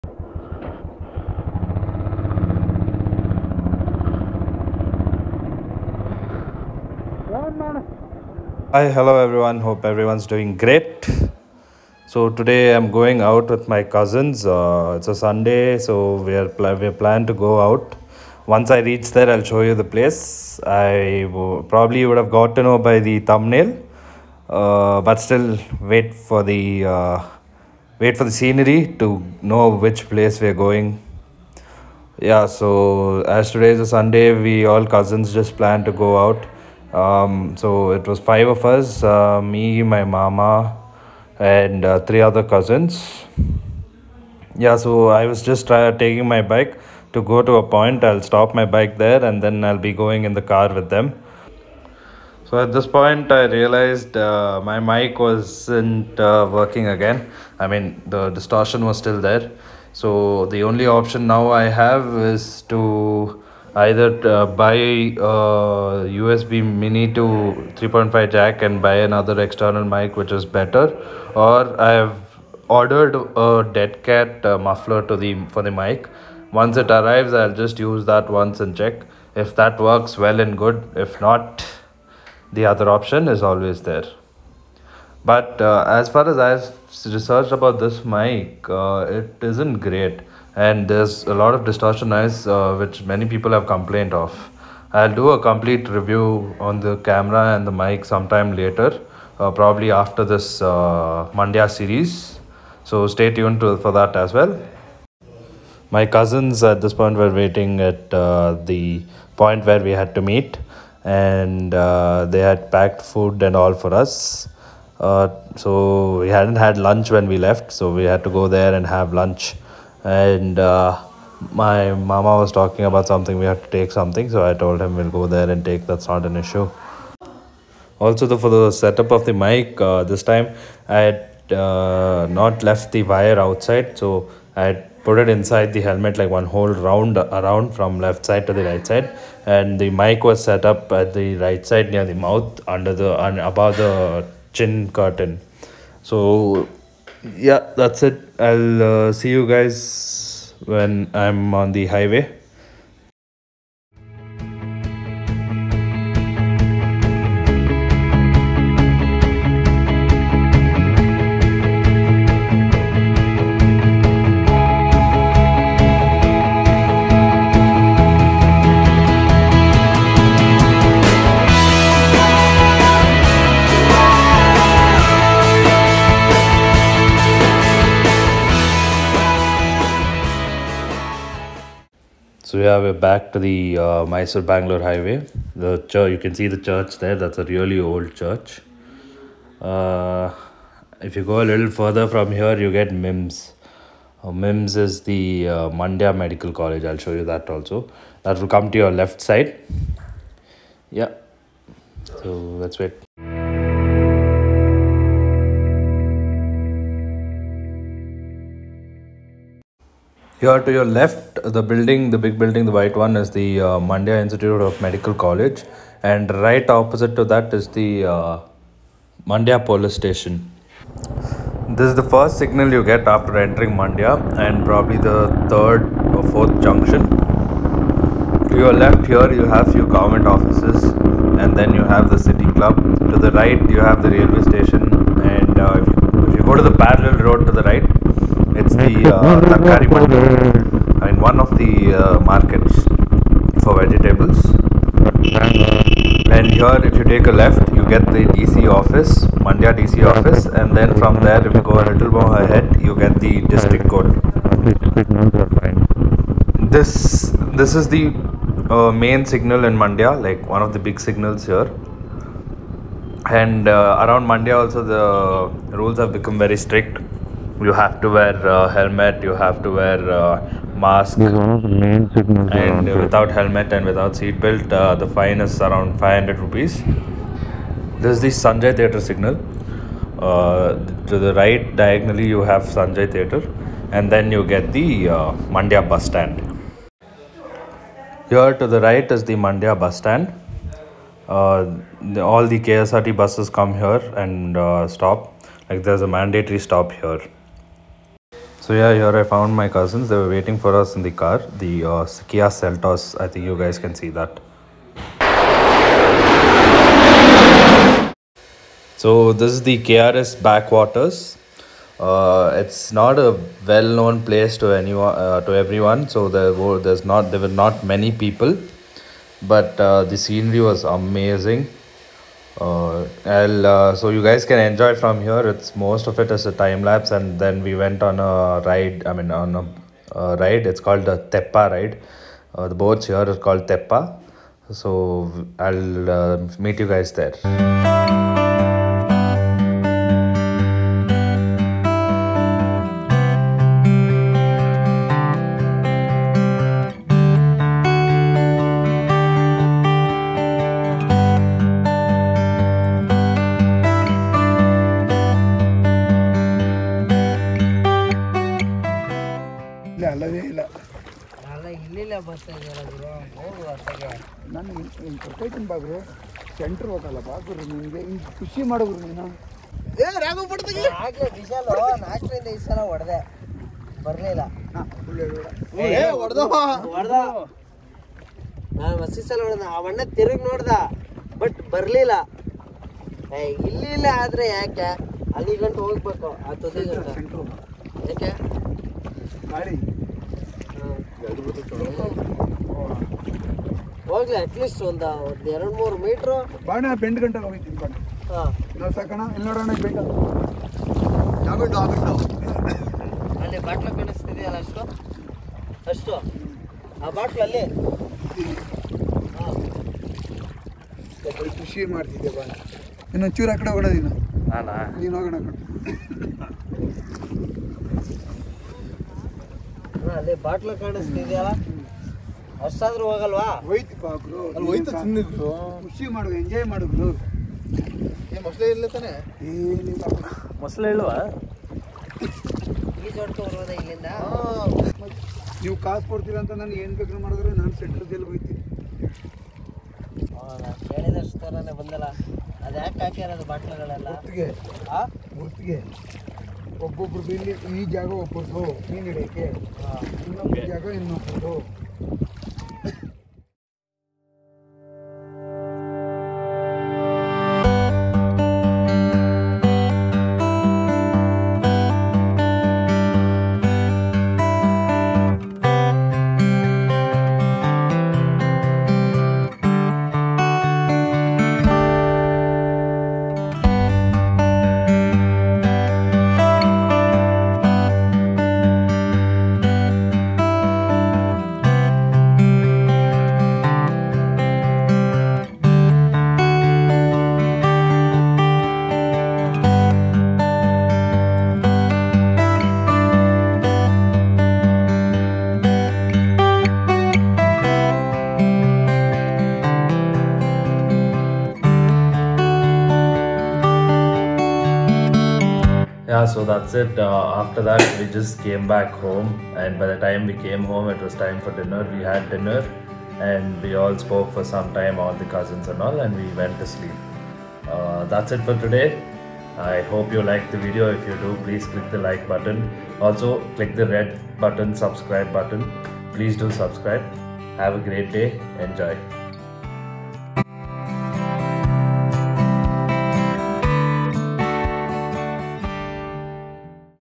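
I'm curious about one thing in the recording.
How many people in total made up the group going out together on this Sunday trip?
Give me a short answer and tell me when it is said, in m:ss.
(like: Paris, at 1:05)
5, at 0:38.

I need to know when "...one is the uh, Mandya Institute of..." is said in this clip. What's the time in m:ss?
3:32.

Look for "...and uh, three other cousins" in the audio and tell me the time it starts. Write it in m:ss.
0:41.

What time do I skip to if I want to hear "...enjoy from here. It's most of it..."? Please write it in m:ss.
5:24.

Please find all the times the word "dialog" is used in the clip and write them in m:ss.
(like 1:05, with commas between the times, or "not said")
not said.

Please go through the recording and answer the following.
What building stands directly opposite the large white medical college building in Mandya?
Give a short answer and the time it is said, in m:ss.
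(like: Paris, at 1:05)
Mandya Police Station, at 3:39.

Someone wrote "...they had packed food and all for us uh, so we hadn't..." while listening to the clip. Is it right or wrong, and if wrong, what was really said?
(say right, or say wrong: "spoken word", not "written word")
right.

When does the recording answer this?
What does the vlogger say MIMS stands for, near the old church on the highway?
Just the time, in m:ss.
3:15.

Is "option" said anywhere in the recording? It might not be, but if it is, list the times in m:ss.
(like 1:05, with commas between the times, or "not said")
1:00, 1:22.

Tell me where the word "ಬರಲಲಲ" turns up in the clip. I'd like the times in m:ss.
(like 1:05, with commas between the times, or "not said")
6:14, 6:21.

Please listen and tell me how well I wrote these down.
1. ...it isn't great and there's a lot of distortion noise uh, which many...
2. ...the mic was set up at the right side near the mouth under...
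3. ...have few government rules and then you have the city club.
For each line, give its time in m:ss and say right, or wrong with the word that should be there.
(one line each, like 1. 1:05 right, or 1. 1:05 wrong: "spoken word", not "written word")
1. 1:29 right
2. 2:19 right
3. 3:49 wrong: "offices", not "rules".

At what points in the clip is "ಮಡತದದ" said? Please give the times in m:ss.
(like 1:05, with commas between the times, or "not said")
6:51.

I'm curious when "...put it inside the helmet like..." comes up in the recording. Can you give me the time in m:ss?
2:15.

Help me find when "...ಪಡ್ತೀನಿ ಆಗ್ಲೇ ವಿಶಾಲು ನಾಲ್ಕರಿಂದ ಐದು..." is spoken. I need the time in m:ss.
6:10.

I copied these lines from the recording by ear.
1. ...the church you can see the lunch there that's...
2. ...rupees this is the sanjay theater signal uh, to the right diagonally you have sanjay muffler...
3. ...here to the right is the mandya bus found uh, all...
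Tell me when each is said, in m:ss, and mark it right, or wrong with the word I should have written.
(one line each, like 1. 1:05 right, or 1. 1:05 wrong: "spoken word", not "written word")
1. 3:05 wrong: "church", not "lunch"
2. 4:36 wrong: "theater", not "muffler"
3. 4:48 wrong: "stand", not "found".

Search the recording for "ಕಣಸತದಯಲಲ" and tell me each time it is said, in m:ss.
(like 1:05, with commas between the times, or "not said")
6:43, 7:00.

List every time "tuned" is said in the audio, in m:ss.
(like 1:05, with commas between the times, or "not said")
1:43.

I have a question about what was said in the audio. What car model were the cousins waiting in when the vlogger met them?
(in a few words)
Kia Seltos.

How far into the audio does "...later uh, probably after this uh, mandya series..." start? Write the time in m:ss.
1:38.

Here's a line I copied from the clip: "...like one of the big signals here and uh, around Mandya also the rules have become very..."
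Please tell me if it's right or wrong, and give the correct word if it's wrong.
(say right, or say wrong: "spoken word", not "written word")
right.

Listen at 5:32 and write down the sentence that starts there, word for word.
Uh, the boats here are called Teppa.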